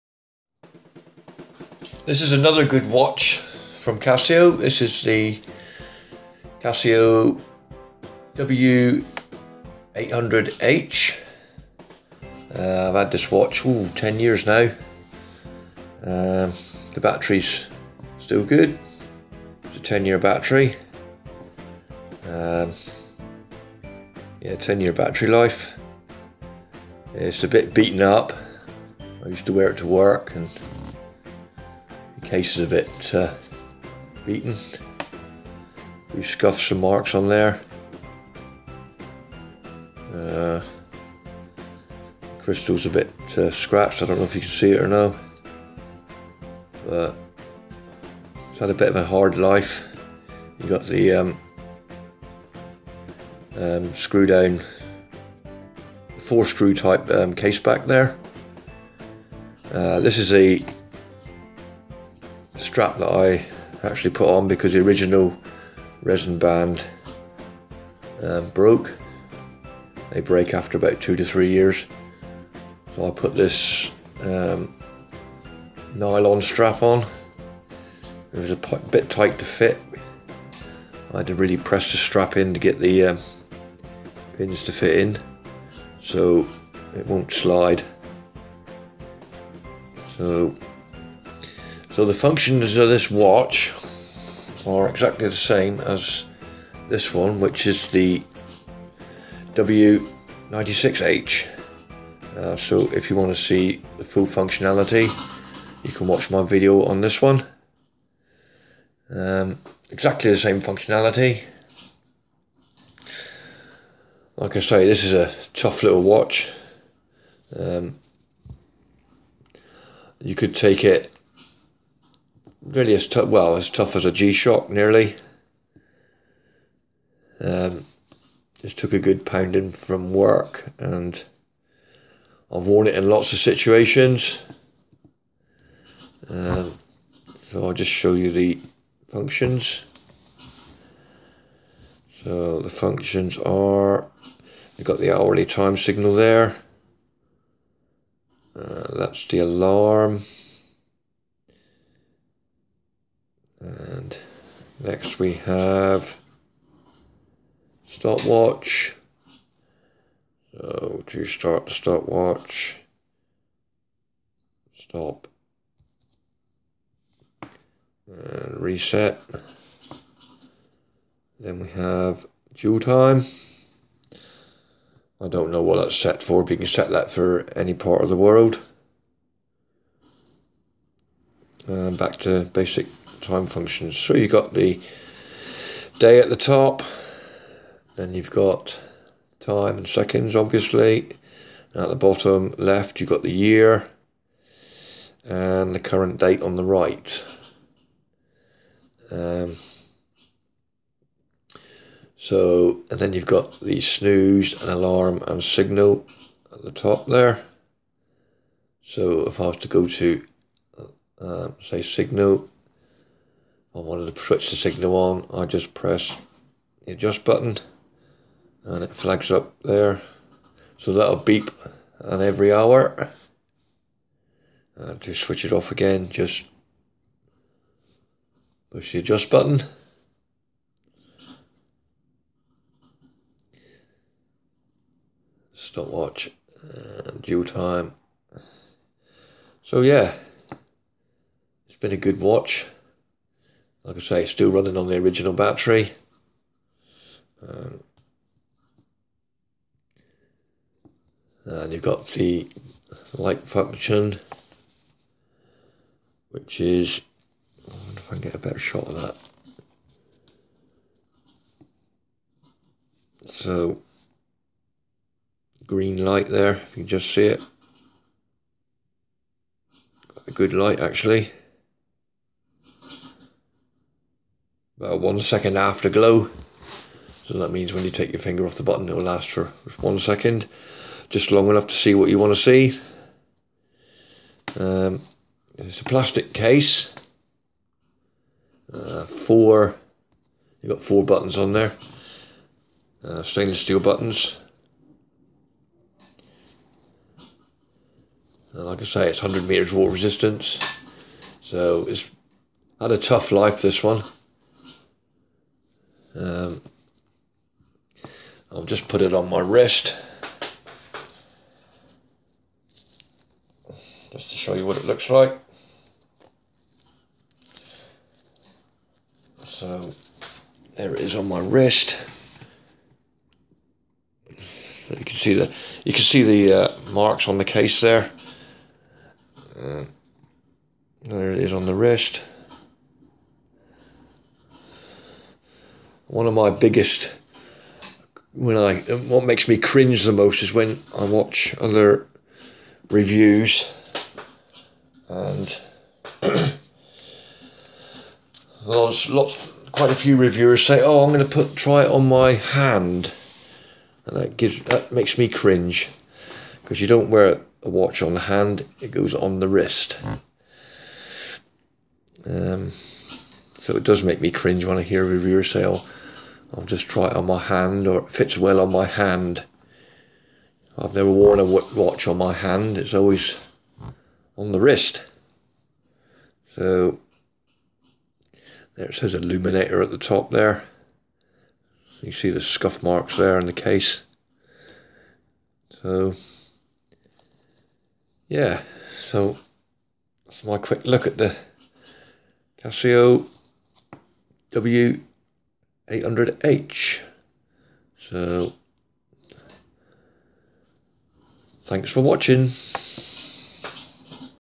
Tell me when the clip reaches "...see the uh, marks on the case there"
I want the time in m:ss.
5:26.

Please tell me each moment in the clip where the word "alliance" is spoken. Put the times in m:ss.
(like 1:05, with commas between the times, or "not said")
not said.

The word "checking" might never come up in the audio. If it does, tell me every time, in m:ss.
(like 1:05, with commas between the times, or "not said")
not said.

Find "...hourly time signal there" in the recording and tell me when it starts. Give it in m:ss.
2:25.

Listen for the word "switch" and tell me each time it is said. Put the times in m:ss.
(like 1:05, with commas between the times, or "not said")
3:34, 3:45.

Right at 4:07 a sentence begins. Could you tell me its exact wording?
Um, and you've got the light function, which is, I wonder if I can get a better shot of that.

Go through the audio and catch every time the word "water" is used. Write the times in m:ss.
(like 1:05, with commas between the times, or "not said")
4:59.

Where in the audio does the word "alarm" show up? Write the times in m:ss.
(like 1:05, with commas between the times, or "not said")
2:29, 3:24.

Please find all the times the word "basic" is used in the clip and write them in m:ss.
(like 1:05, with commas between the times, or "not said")
3:02.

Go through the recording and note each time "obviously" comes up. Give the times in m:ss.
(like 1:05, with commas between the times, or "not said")
3:10.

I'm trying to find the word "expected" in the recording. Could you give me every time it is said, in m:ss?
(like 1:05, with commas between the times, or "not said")
not said.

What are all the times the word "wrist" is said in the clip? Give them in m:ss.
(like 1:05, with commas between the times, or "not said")
5:09, 5:21, 5:31, 5:59, 6:14.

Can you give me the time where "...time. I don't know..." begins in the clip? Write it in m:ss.
2:52.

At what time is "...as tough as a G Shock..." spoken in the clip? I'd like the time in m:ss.
2:03.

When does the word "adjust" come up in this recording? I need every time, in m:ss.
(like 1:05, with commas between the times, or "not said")
3:36, 3:48.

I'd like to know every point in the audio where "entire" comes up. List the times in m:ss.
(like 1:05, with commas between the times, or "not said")
not said.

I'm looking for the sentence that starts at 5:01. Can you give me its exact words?
So it's had a tough life, this one.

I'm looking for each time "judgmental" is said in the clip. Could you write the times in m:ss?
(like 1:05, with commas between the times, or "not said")
not said.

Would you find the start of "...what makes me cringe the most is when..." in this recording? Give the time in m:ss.
5:39.